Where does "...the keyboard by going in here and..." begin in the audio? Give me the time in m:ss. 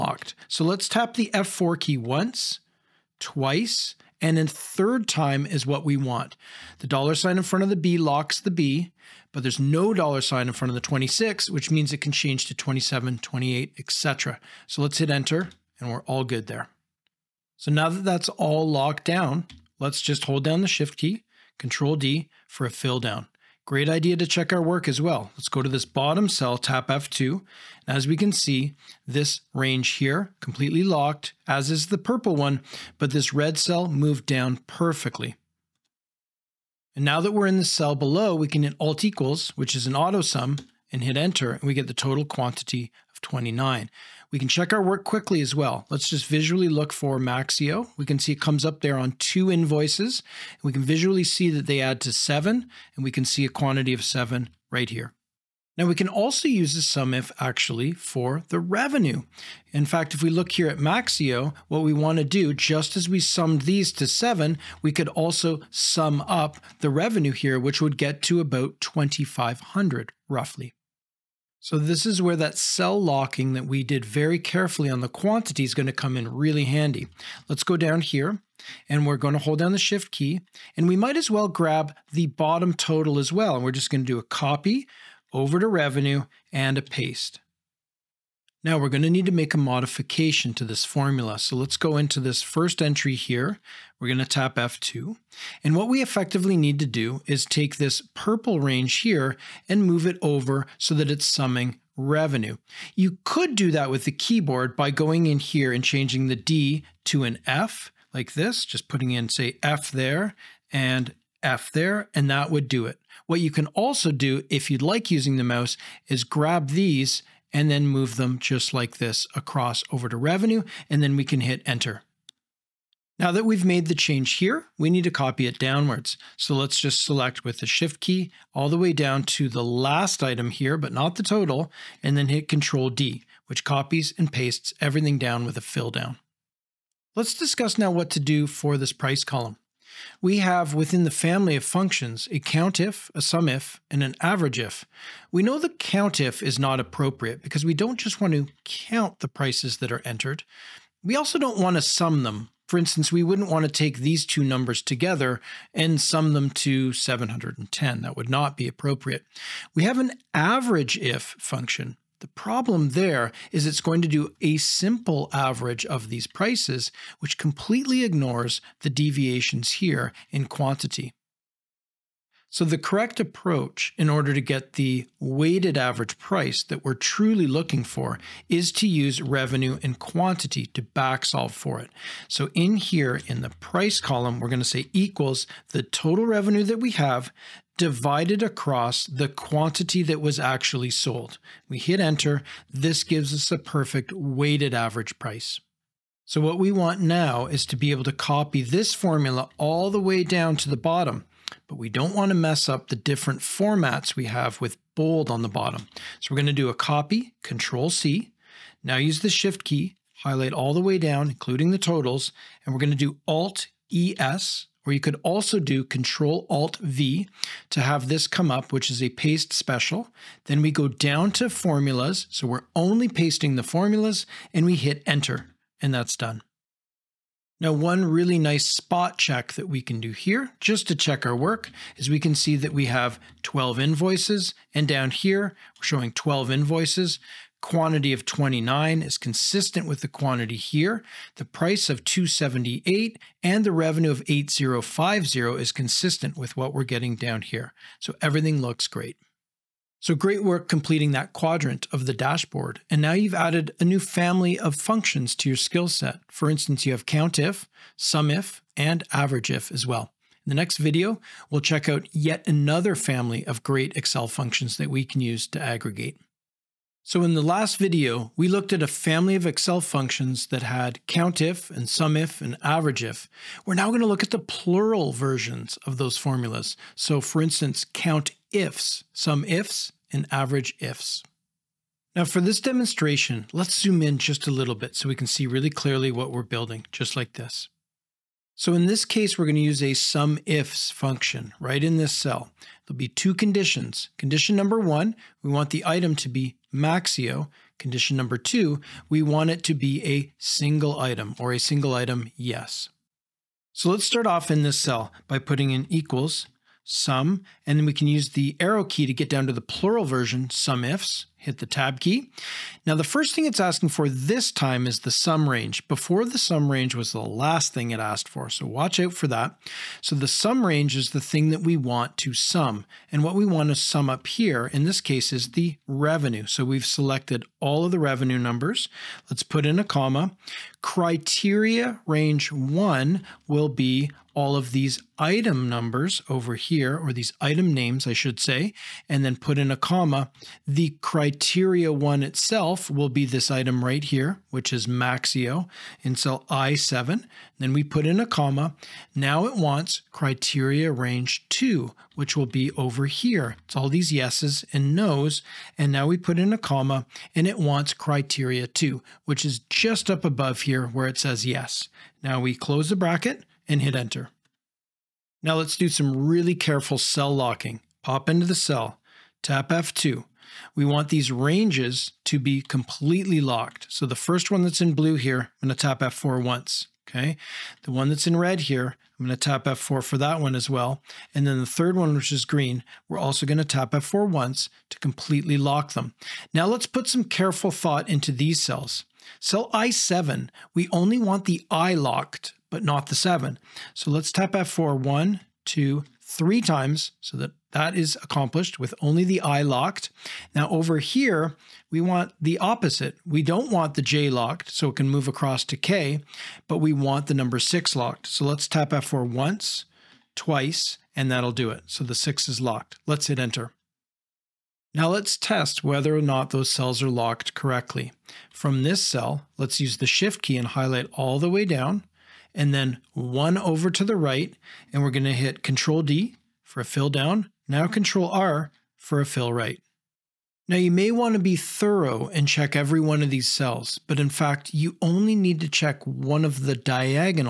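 1:44.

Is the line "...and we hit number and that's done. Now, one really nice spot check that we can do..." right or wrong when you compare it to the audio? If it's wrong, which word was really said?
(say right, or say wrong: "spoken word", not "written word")
wrong: "enter", not "number".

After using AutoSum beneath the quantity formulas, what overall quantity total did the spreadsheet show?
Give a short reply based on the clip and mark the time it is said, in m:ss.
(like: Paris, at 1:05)
29, at 0:41.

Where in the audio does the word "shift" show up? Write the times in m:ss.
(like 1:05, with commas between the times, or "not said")
0:20, 1:19, 2:07, 3:29, 7:00.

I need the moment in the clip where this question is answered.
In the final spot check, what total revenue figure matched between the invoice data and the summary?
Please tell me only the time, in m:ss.
4:03.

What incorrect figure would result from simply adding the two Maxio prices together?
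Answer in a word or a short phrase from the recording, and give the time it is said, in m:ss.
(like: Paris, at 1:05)
710, at 2:35.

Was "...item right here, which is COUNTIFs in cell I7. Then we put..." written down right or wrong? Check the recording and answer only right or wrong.
wrong.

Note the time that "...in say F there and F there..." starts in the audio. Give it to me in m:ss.
1:49.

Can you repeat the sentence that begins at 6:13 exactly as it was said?
So the first one that's in blue here, I'm going to tap F4 once.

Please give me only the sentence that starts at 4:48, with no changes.
So in this case, we're going to use a sum ifs function right in this cell.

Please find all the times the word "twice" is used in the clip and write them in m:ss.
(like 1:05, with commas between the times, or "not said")
0:03, 6:50.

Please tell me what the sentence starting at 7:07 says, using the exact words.
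Now Control R for a fill right.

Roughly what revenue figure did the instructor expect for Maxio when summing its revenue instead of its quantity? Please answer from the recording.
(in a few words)
2,500.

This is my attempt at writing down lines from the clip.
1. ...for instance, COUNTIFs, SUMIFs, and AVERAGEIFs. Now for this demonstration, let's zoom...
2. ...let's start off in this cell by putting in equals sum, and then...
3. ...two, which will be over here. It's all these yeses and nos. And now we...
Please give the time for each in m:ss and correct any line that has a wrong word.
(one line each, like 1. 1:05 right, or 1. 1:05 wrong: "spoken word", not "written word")
1. 4:37 right
2. 5:03 right
3. 5:51 right.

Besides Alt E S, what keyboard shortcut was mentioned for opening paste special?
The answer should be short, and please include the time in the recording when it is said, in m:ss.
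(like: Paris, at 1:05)
Control Alt V, at 3:35.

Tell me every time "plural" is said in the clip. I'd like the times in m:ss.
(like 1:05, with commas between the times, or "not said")
4:34, 5:09.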